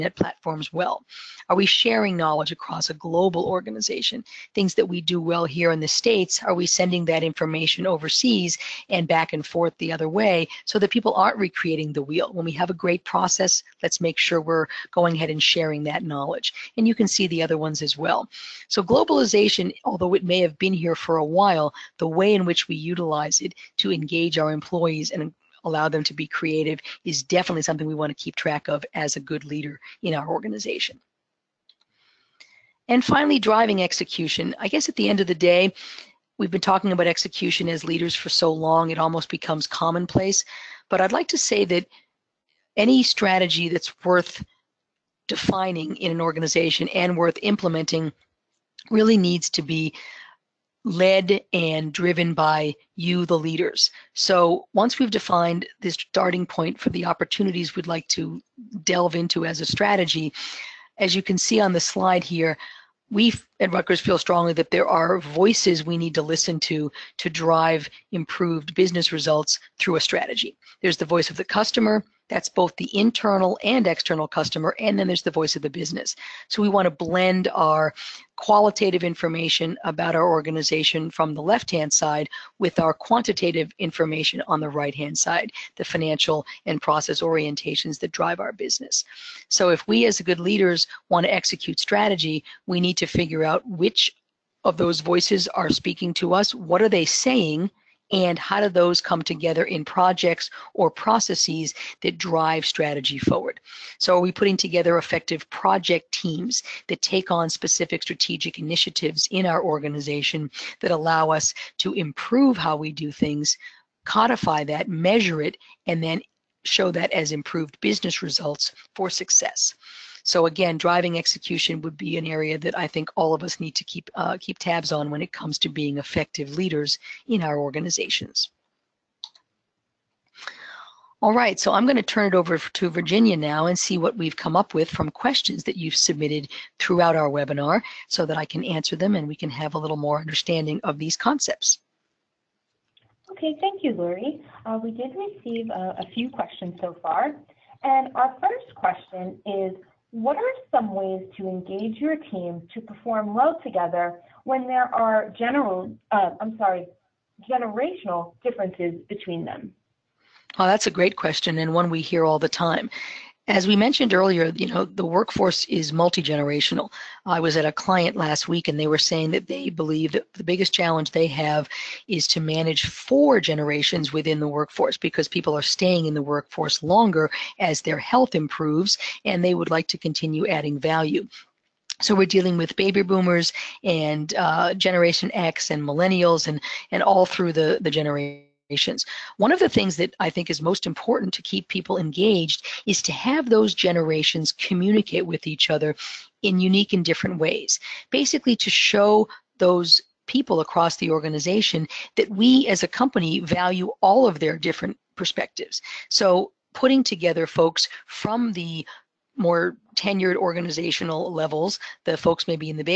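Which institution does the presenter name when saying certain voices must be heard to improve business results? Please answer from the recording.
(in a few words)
Rutgers.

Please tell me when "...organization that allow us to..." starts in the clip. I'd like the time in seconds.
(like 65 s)
109 s.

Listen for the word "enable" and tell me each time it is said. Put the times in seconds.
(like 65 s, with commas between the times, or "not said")
not said.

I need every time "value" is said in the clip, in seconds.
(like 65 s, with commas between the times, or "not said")
180 s, 203 s.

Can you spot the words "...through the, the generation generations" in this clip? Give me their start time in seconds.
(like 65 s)
187 s.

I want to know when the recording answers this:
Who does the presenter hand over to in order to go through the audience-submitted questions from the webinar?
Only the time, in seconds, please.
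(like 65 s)
132 s.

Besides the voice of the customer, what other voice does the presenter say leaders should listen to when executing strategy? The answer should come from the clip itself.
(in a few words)
the voice of the business.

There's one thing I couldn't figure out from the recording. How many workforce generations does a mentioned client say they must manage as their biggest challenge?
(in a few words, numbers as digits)
4.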